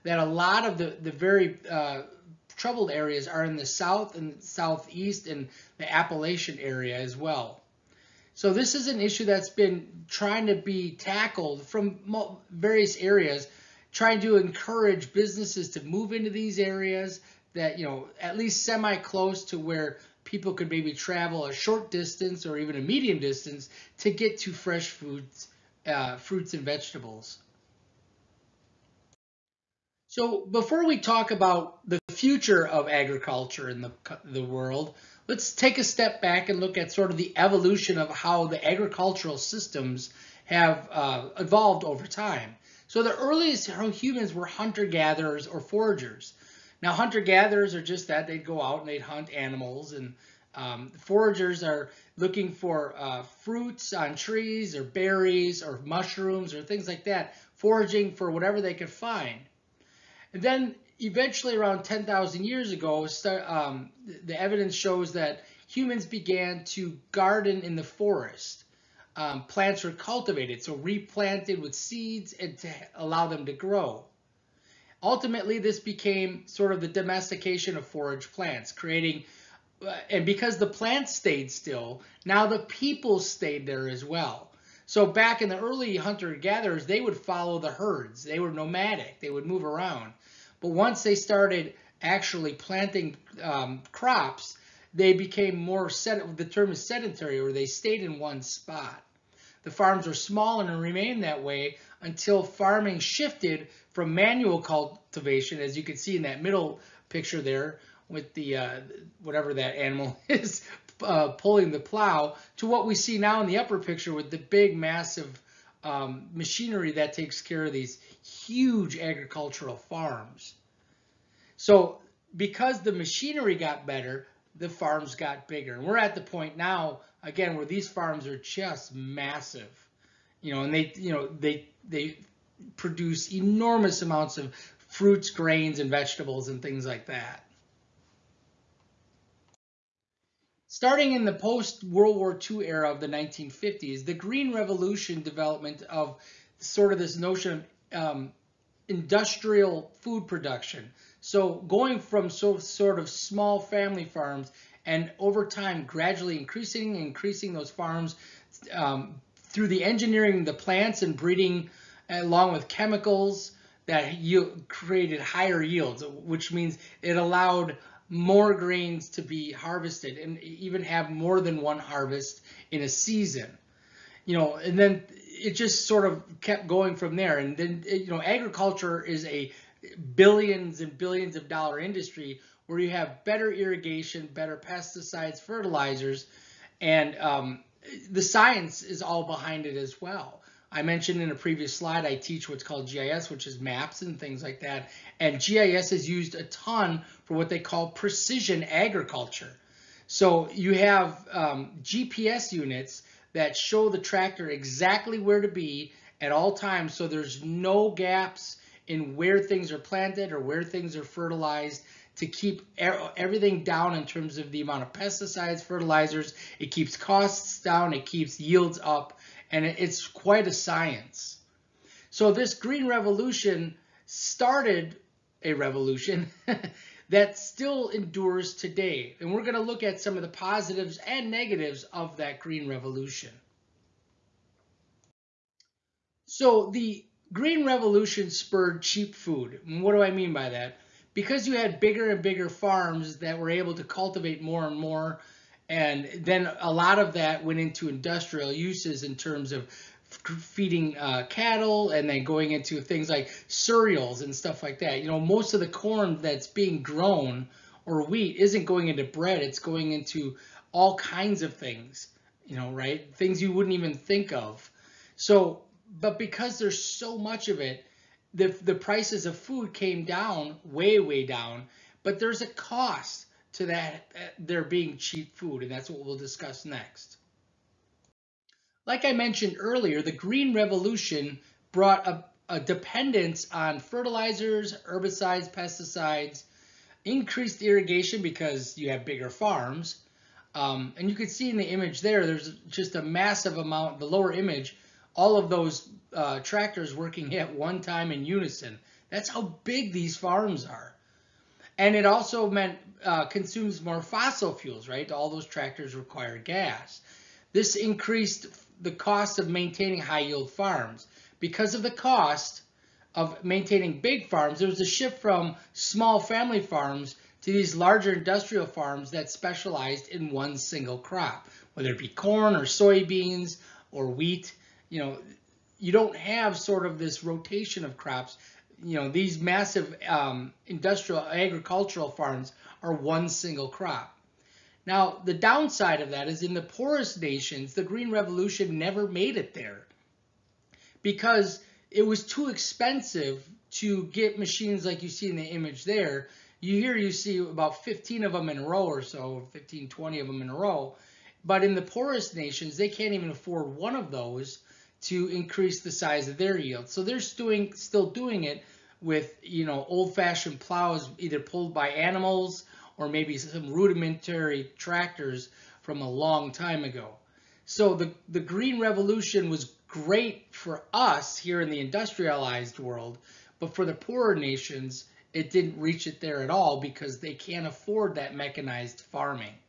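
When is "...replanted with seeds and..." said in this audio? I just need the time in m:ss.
1:10.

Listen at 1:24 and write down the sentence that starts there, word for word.
So back in the early hunter-gatherers, they would follow the herds.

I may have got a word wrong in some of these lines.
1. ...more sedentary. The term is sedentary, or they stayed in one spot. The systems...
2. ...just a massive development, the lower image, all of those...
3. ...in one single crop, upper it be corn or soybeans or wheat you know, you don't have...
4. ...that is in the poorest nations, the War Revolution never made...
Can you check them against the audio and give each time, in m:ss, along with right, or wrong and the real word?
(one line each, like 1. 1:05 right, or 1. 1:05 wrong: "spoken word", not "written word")
1. 1:35 wrong: "farms", not "systems"
2. 4:52 wrong: "amount", not "development"
3. 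5:20 wrong: "whether", not "upper"
4. 5:36 wrong: "Green", not "War".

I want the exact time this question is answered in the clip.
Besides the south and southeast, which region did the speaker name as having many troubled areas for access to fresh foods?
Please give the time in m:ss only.
0:05.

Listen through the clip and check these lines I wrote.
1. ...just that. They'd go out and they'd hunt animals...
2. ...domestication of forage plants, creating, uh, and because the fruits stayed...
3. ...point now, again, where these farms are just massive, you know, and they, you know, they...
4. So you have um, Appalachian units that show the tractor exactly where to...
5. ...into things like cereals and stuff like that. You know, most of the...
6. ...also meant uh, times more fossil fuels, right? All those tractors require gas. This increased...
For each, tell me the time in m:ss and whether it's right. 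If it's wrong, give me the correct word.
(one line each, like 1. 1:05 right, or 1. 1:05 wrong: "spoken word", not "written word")
1. 0:47 right
2. 1:16 wrong: "plants", not "fruits"
3. 2:06 right
4. 3:20 wrong: "GPS", not "Appalachian"
5. 4:12 right
6. 5:02 wrong: "consumes", not "times".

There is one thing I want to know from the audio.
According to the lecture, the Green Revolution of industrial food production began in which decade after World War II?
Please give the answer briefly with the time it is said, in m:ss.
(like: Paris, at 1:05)
1950s, at 2:23.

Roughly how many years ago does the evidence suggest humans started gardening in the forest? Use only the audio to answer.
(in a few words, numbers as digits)
10,000 years.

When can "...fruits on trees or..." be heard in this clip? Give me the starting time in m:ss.
0:53.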